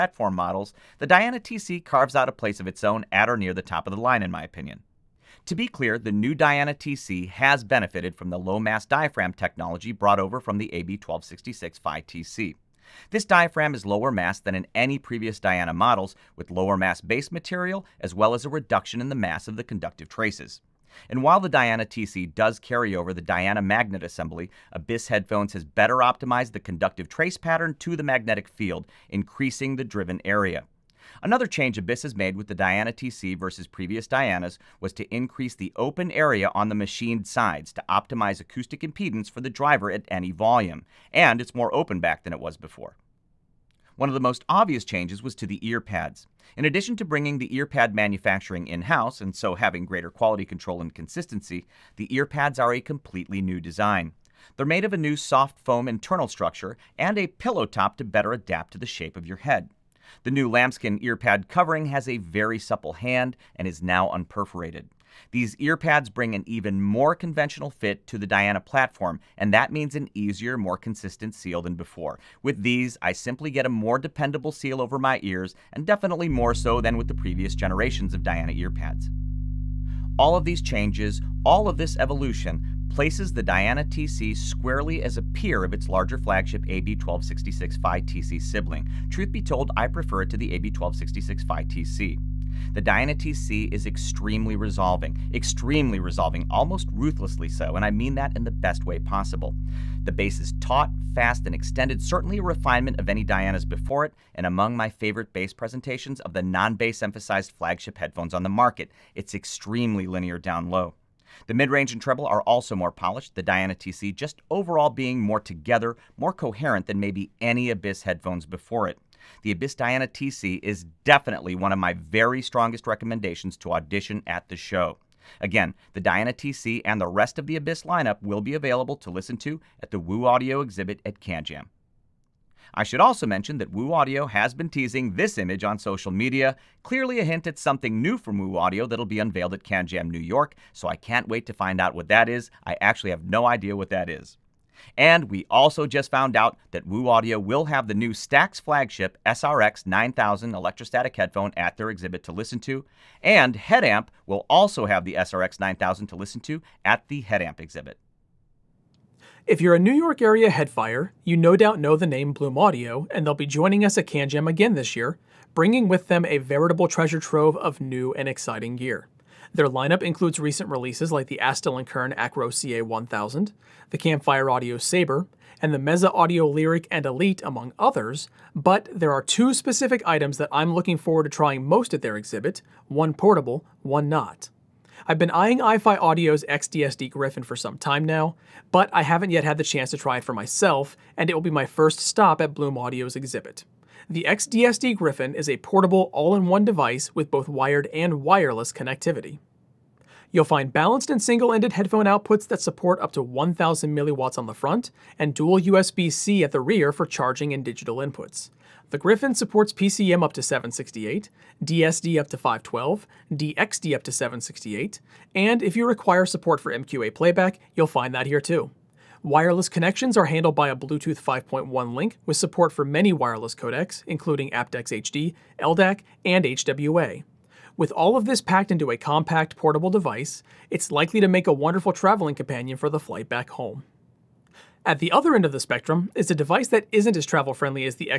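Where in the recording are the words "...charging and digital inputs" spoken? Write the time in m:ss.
3:27.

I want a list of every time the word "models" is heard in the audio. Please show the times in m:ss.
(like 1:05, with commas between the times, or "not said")
0:00, 0:15.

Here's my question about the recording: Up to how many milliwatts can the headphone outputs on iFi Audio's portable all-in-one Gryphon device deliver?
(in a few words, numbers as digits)
1000 milliwatts.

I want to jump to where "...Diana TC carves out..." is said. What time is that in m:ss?
0:01.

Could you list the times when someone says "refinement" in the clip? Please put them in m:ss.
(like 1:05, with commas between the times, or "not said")
1:42.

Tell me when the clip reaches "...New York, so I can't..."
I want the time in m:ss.
2:20.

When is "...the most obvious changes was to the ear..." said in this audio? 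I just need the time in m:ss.
0:44.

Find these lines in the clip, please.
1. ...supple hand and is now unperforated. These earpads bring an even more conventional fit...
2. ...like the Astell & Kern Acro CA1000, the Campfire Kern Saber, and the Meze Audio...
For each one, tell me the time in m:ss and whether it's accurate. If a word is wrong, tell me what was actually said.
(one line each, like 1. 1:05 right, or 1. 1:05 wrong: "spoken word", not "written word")
1. 1:02 right
2. 2:51 wrong: "Audio", not "Kern".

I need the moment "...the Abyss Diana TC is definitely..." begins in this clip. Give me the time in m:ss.
1:59.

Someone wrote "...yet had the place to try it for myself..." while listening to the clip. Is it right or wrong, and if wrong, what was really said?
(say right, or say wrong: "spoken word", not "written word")
wrong: "chance", not "place".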